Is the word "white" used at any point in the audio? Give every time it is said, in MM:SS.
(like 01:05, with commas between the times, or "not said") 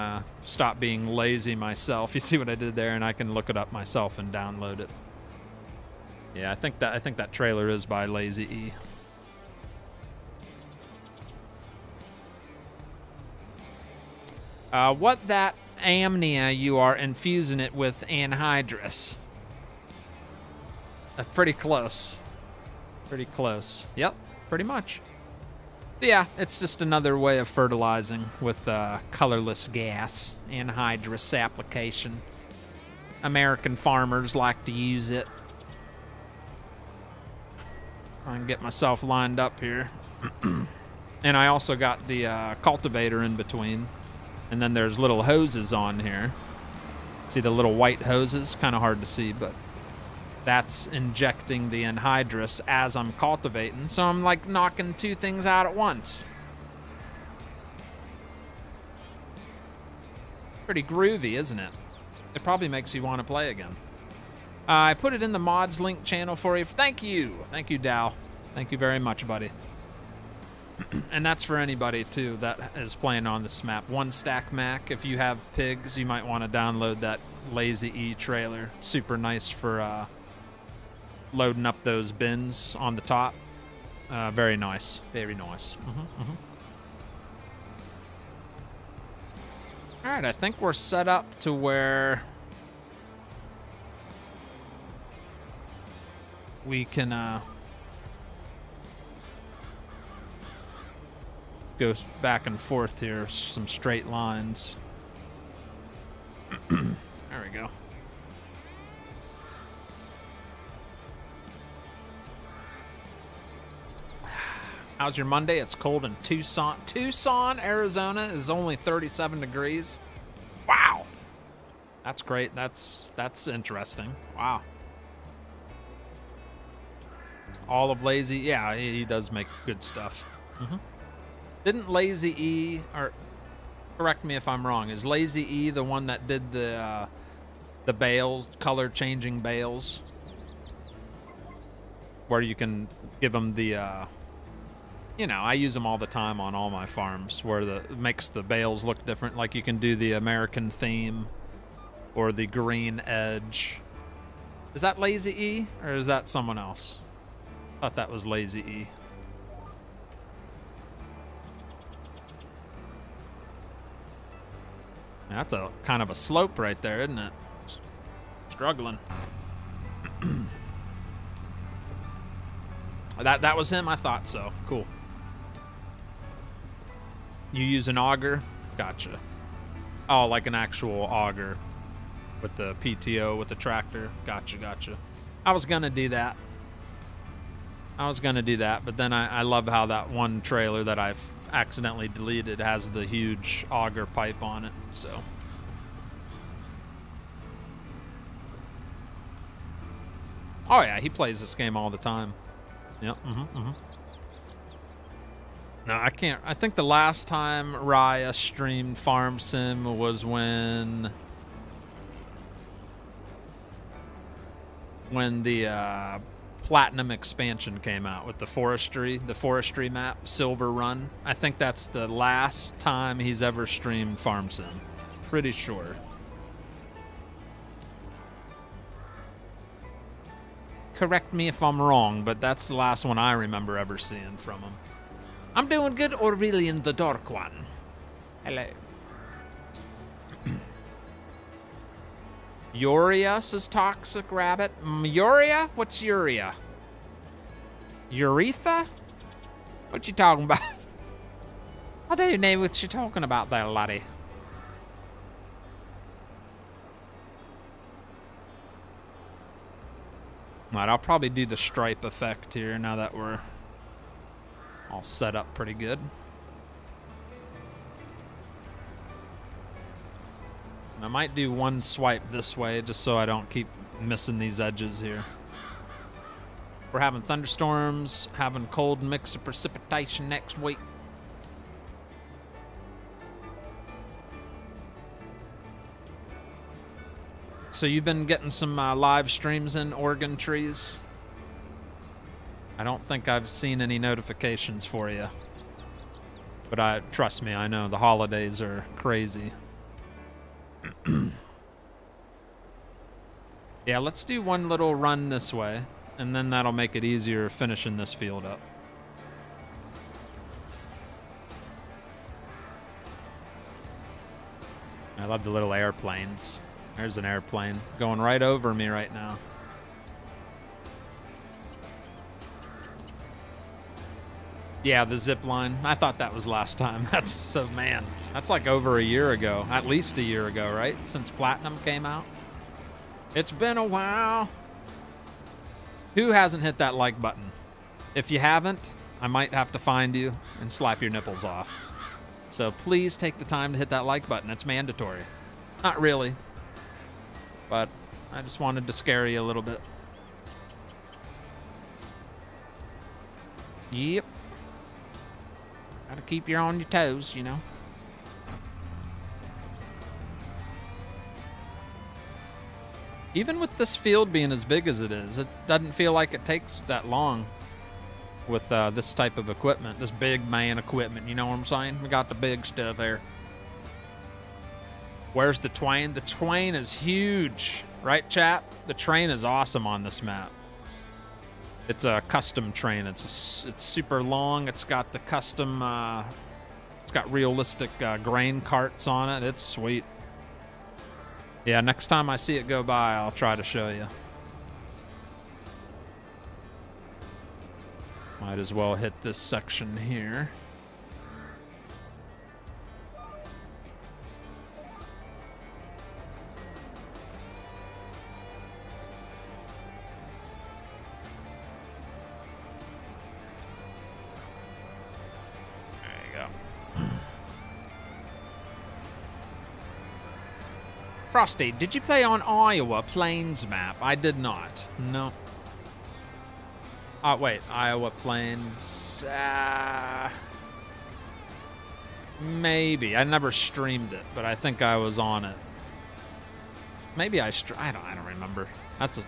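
00:47.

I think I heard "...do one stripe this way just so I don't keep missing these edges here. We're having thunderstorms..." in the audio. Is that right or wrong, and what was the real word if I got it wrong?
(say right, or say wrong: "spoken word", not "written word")
wrong: "swipe", not "stripe".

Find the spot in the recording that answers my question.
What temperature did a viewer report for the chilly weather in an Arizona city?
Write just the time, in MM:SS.
01:58.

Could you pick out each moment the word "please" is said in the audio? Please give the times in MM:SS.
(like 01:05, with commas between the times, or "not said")
05:42.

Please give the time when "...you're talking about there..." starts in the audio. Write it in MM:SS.
04:12.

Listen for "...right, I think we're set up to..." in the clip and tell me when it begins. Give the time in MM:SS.
01:30.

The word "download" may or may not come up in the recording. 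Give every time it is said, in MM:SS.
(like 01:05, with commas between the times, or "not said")
00:04, 01:16.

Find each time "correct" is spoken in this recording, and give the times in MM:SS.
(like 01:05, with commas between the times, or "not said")
02:13, 03:50.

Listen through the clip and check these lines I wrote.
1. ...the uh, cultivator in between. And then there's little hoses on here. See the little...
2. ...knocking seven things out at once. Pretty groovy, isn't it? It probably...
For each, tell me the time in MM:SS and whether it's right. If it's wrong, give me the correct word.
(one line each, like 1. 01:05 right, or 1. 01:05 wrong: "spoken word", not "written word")
1. 00:42 right
2. 00:54 wrong: "two", not "seven".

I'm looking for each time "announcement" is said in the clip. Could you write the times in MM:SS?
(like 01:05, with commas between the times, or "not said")
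not said.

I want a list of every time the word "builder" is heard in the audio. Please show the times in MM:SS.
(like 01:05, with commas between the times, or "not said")
not said.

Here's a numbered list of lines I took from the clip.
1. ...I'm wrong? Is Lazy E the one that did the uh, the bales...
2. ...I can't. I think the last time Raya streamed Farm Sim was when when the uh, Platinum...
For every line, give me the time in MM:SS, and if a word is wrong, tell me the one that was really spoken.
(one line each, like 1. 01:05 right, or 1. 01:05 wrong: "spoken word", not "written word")
1. 02:14 right
2. 03:25 right.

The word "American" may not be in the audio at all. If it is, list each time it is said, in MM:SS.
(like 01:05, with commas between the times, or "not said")
00:33, 02:30.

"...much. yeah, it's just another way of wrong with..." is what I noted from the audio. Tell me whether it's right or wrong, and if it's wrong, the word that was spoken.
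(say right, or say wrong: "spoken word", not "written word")
wrong: "fertilizing", not "wrong".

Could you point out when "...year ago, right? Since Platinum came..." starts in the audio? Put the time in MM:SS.
05:30.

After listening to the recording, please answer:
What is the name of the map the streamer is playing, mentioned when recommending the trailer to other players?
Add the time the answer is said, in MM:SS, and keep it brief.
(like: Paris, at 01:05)
One Stack Mac, at 01:13.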